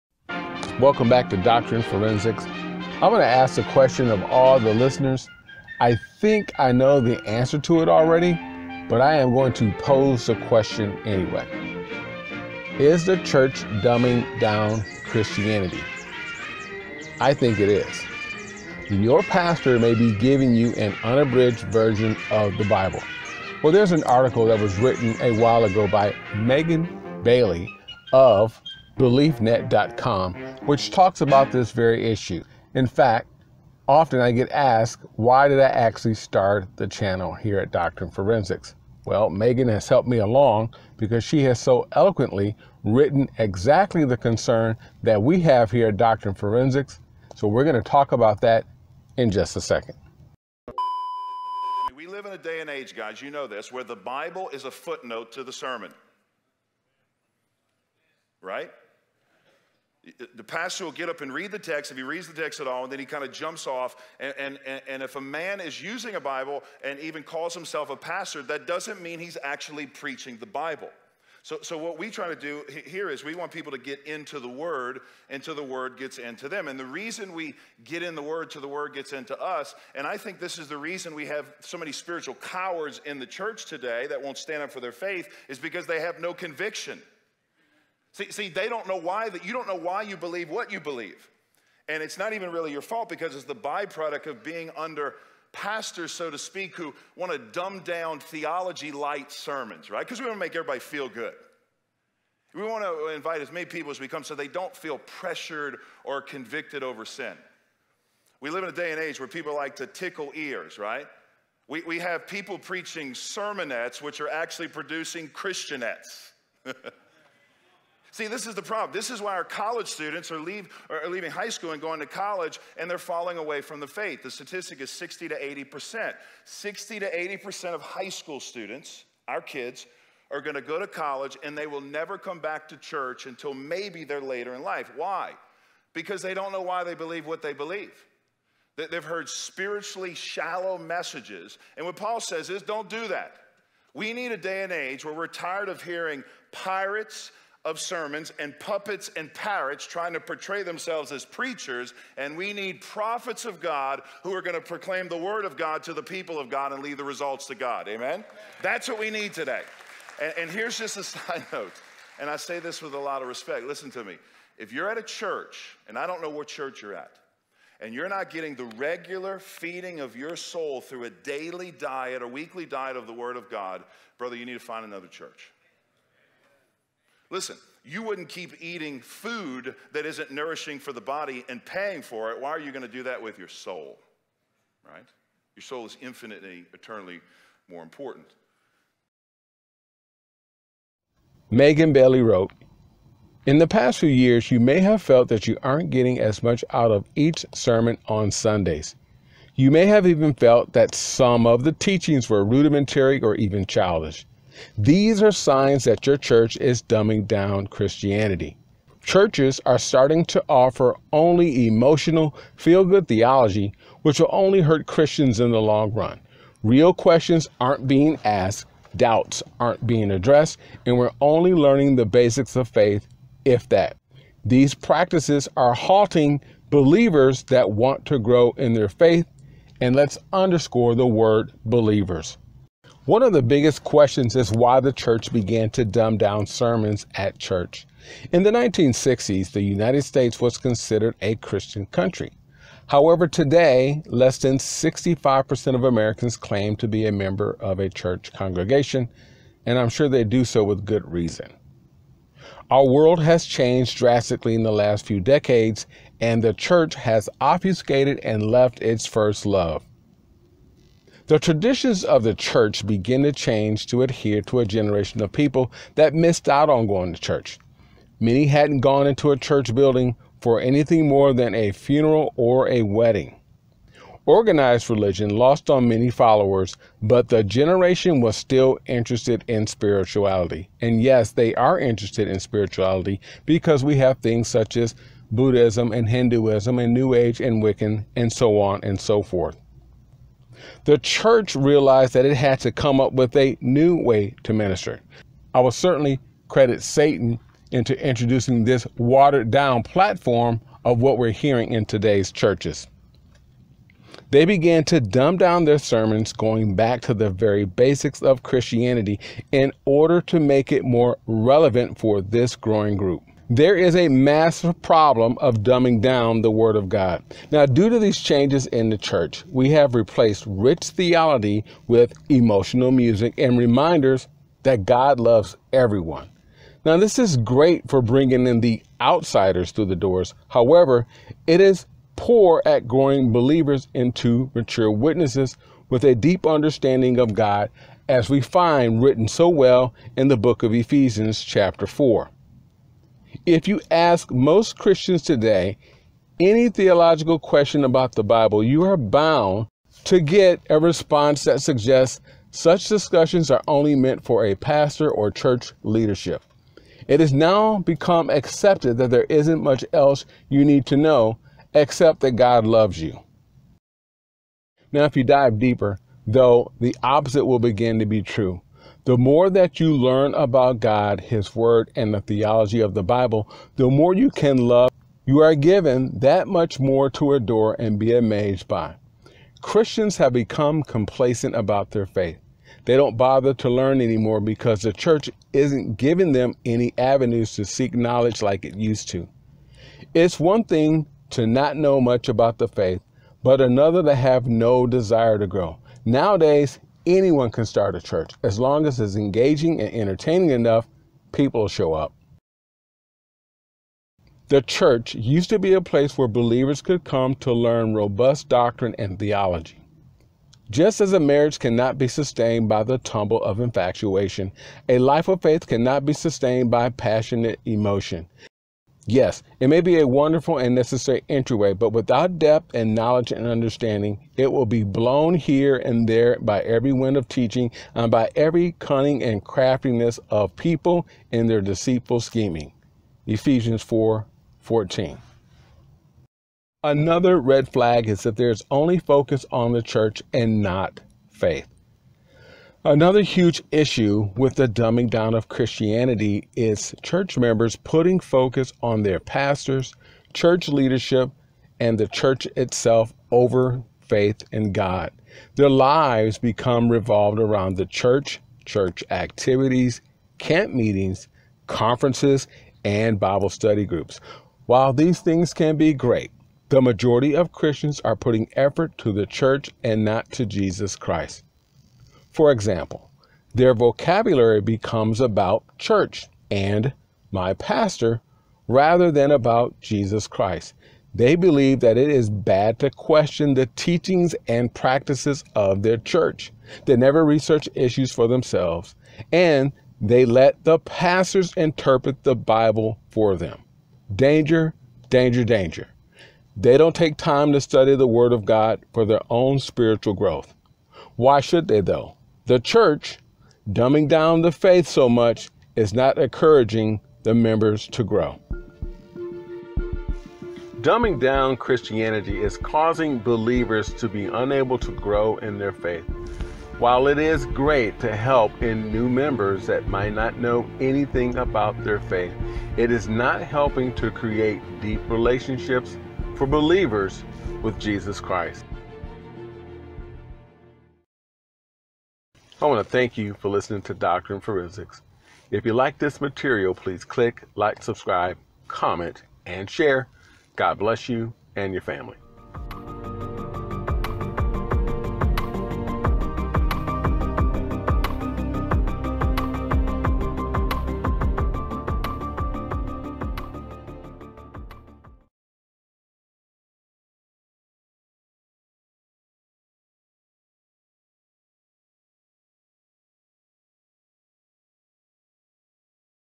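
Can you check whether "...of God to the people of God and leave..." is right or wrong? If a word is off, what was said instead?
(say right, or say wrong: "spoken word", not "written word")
right.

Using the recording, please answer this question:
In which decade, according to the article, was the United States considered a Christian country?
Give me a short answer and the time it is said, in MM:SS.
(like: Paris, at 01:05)
1960s, at 03:58.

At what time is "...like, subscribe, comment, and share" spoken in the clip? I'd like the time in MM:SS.
08:57.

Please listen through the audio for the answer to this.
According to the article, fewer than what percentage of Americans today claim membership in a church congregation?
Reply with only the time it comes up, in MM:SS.
04:04.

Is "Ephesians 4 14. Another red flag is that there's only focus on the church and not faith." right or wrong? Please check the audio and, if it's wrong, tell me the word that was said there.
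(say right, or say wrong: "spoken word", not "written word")
right.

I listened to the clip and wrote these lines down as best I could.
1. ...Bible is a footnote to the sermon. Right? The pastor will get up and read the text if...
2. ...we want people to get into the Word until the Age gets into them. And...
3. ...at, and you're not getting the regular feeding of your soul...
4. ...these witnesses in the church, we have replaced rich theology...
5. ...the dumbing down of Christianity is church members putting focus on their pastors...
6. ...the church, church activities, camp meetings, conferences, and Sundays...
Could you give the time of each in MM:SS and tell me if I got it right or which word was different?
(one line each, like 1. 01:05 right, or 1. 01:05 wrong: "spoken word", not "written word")
1. 00:53 right
2. 01:13 wrong: "Word", not "Age"
3. 02:46 right
4. 05:17 wrong: "changes", not "witnesses"
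5. 07:24 right
6. 07:37 wrong: "Bible", not "Sundays".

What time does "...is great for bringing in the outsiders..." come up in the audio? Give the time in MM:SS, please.
05:27.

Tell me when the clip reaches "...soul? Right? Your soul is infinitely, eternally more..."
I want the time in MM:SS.
03:03.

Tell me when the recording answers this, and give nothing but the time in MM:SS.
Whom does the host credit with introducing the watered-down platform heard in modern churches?
04:56.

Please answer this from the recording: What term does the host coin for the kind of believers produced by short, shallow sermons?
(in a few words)
Christianettes.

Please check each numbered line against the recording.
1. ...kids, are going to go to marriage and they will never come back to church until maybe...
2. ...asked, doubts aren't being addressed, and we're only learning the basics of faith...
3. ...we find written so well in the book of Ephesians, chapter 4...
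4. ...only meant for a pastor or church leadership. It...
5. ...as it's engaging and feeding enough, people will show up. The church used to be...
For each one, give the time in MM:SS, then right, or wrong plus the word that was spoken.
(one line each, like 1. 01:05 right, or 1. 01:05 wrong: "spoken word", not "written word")
1. 02:09 wrong: "college", not "marriage"
2. 03:38 right
3. 05:38 right
4. 05:53 right
5. 06:38 wrong: "entertaining", not "feeding".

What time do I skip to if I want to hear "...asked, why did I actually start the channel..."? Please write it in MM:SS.
00:34.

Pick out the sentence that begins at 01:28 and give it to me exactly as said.
See, see, they don't know why that you don't know why you believe what you believe.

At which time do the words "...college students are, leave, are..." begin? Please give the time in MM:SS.
01:59.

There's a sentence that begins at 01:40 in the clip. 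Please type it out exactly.
Because we want to make everybody feel good.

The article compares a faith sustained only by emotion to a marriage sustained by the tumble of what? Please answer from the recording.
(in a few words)
infatuation.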